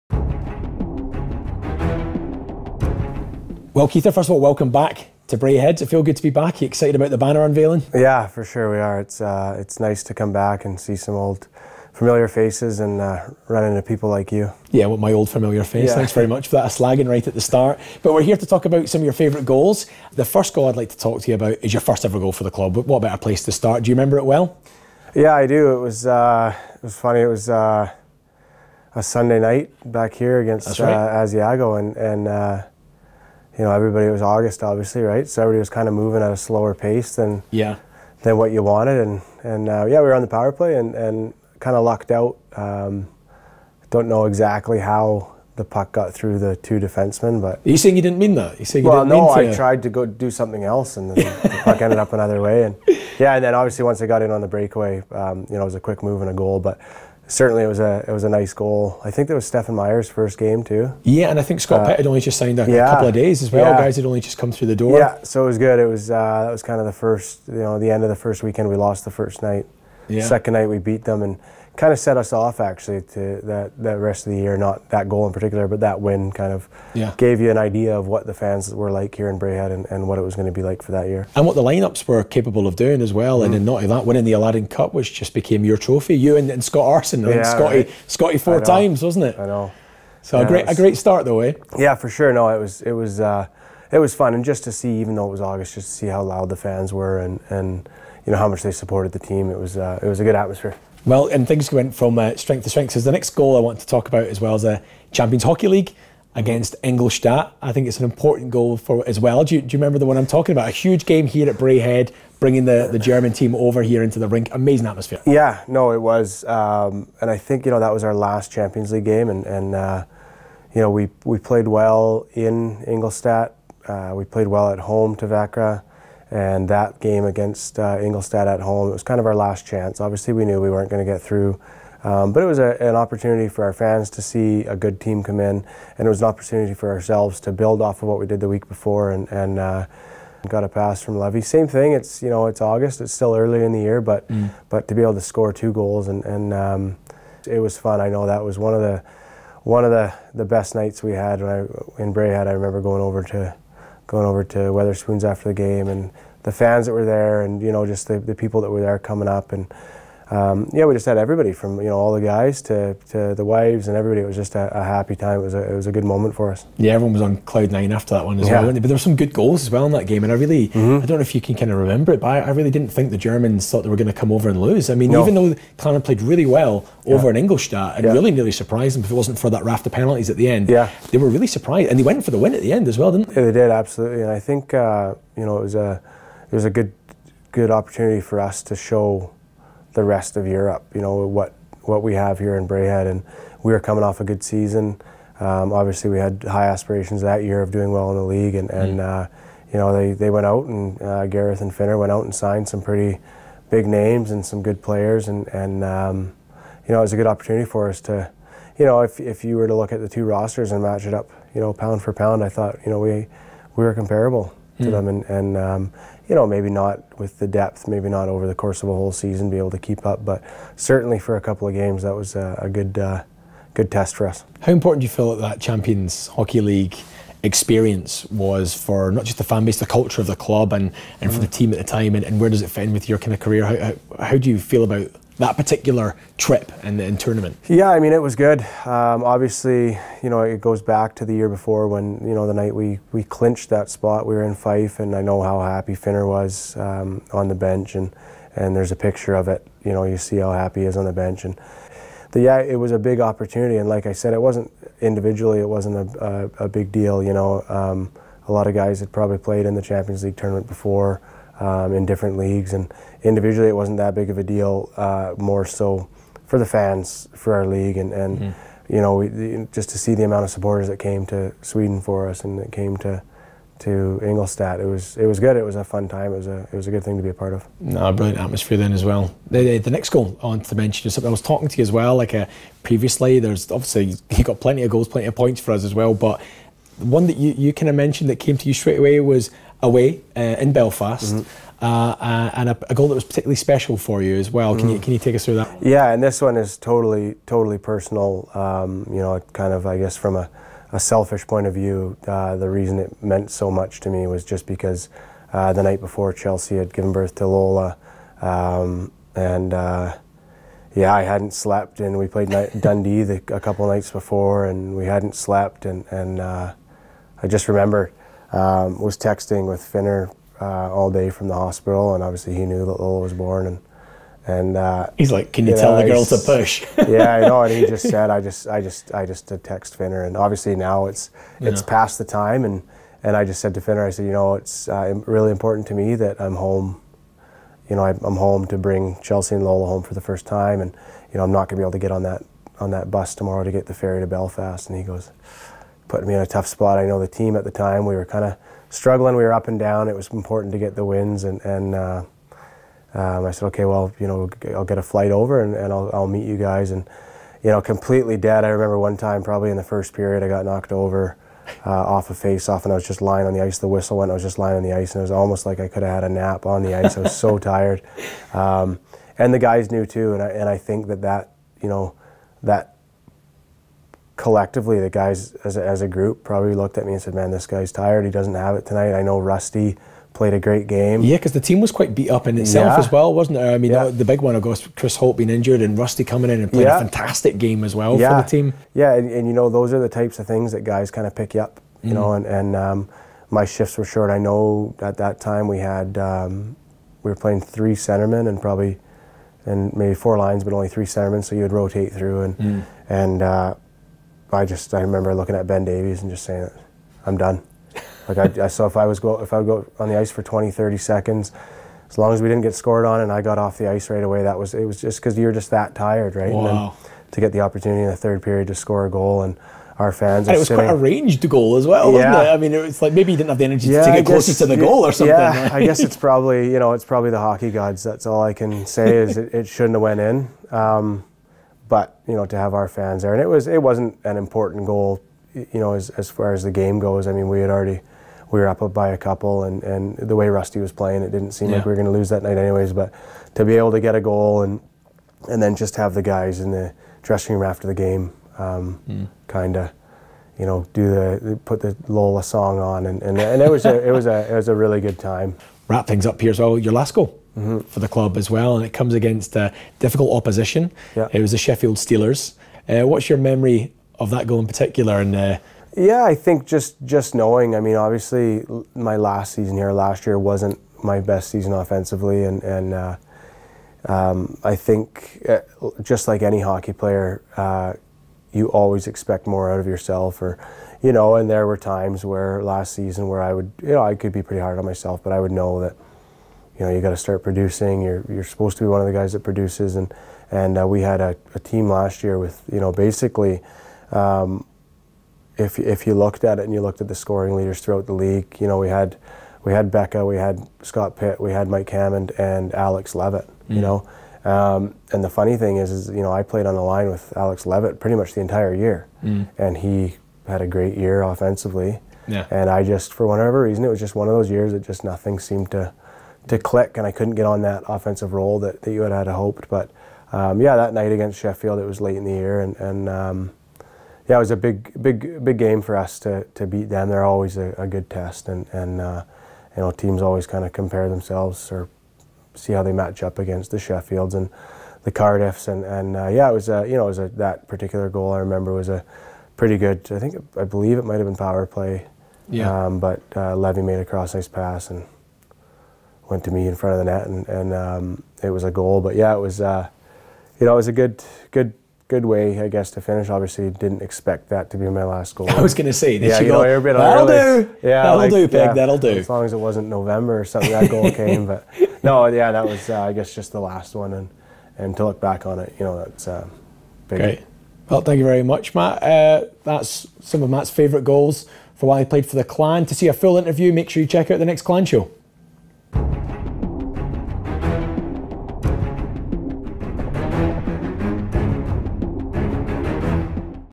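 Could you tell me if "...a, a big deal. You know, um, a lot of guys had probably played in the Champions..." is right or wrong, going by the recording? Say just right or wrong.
right.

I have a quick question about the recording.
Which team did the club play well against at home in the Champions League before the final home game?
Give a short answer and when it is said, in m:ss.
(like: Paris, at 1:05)
Vakra, at 2:05.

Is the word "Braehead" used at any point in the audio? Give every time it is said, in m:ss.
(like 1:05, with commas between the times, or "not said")
0:05, 1:19, 1:51, 2:32, 3:12.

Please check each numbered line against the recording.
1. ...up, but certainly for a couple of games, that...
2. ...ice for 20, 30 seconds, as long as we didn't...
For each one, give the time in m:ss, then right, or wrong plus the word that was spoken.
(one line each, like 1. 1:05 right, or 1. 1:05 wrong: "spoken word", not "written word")
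1. 3:40 right
2. 6:50 right.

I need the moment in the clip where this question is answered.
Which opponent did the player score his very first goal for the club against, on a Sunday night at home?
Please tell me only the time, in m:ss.
0:31.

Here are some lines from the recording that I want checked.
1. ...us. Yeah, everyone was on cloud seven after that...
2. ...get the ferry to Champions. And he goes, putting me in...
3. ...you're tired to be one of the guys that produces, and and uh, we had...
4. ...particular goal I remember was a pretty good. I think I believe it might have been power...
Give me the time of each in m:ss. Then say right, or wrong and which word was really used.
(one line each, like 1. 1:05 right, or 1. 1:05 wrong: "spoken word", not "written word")
1. 2:46 wrong: "nine", not "seven"
2. 5:43 wrong: "Belfast", not "Champions"
3. 8:08 wrong: "supposed", not "tired"
4. 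8:57 right.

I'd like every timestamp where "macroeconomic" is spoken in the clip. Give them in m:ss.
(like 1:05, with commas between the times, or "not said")
not said.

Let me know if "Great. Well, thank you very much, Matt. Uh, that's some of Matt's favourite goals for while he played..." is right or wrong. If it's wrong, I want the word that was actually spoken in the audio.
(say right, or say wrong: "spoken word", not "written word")
right.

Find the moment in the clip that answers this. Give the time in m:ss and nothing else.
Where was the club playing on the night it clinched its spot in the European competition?
4:04.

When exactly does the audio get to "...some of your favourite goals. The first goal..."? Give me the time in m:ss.
0:18.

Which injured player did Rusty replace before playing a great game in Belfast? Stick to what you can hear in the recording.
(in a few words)
Chris Holt.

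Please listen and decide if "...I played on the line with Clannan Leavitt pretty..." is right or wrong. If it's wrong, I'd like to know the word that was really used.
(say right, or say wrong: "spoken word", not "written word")
wrong: "Alex", not "Clannan".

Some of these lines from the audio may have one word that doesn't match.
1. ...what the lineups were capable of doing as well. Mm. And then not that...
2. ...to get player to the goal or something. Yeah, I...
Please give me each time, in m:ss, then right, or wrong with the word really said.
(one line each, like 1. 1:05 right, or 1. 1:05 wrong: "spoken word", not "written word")
1. 1:21 right
2. 7:04 wrong: "closer", not "player".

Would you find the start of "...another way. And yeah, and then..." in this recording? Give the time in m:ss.
0:52.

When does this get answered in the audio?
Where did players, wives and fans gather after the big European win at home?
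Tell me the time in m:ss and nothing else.
2:34.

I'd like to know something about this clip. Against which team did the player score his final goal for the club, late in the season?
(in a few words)
Sheffield Steelers.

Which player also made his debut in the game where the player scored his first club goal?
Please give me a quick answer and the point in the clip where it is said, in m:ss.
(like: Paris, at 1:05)
Stefan Meyer, at 0:59.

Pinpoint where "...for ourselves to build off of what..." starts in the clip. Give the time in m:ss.
2:16.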